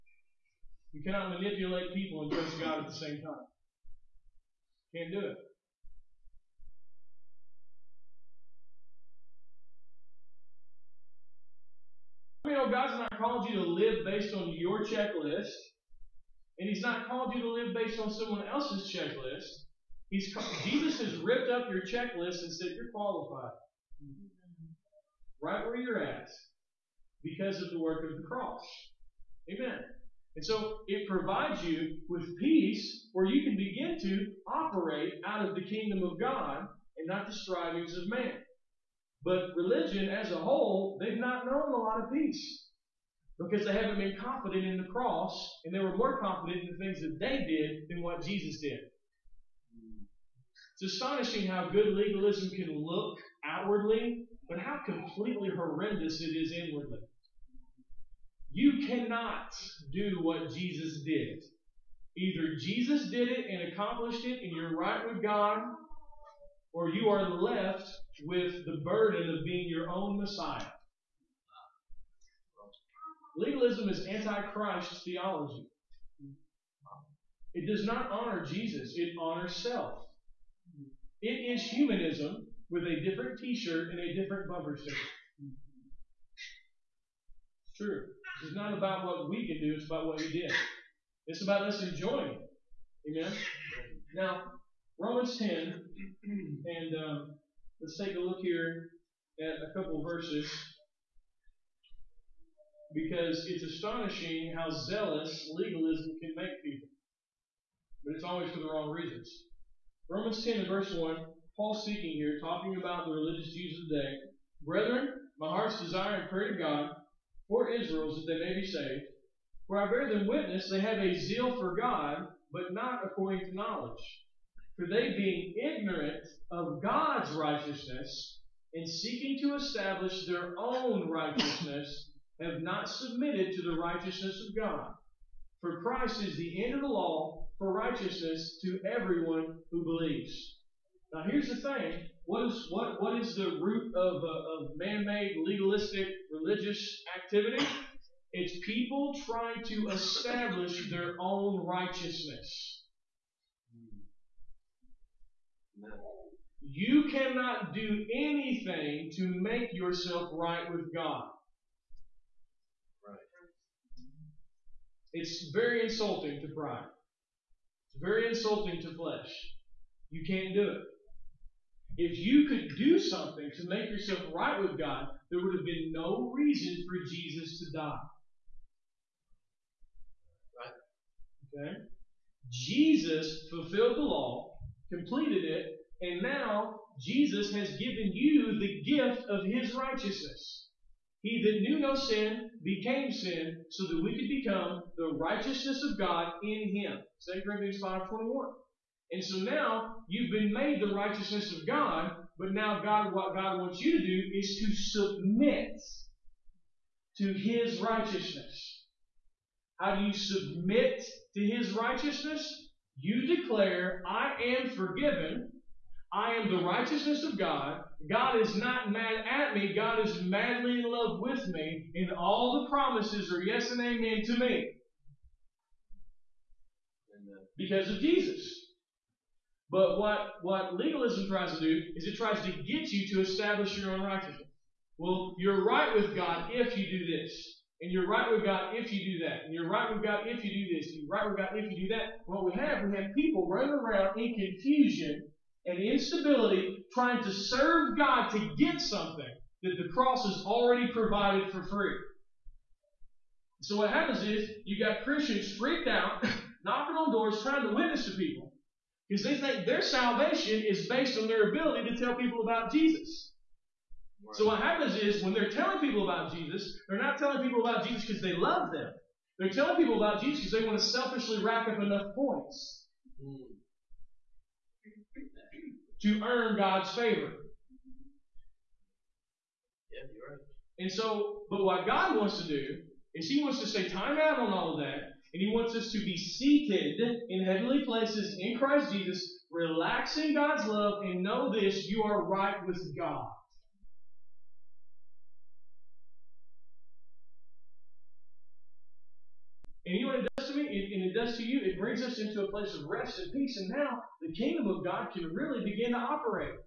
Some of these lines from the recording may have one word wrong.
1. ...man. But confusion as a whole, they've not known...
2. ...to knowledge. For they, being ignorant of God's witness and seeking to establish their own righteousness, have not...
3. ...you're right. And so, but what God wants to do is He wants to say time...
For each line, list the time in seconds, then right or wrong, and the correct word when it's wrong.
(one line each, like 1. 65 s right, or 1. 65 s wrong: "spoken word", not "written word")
1. 38 s wrong: "religion", not "confusion"
2. 123 s wrong: "righteousness", not "witness"
3. 280 s right.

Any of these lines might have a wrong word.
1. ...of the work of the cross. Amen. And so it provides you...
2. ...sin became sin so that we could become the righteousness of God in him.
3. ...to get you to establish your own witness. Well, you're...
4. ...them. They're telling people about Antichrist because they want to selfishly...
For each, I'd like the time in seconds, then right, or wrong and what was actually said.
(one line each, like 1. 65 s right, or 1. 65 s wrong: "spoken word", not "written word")
1. 27 s right
2. 191 s right
3. 232 s wrong: "righteousness", not "witness"
4. 268 s wrong: "Jesus", not "Antichrist".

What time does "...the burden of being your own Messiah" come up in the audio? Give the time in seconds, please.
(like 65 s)
68 s.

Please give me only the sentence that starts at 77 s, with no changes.
It does not honor Jesus, it honors self.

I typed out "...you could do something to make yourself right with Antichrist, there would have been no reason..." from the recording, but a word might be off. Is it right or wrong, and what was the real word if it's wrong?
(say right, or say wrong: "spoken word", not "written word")
wrong: "God", not "Antichrist".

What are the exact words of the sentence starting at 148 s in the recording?
It's people trying to establish their own righteousness.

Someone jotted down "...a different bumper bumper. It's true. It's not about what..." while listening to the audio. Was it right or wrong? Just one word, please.
wrong.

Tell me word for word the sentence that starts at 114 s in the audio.
Brethren, my heart's desire and prayer to God for Israel is that they may be saved.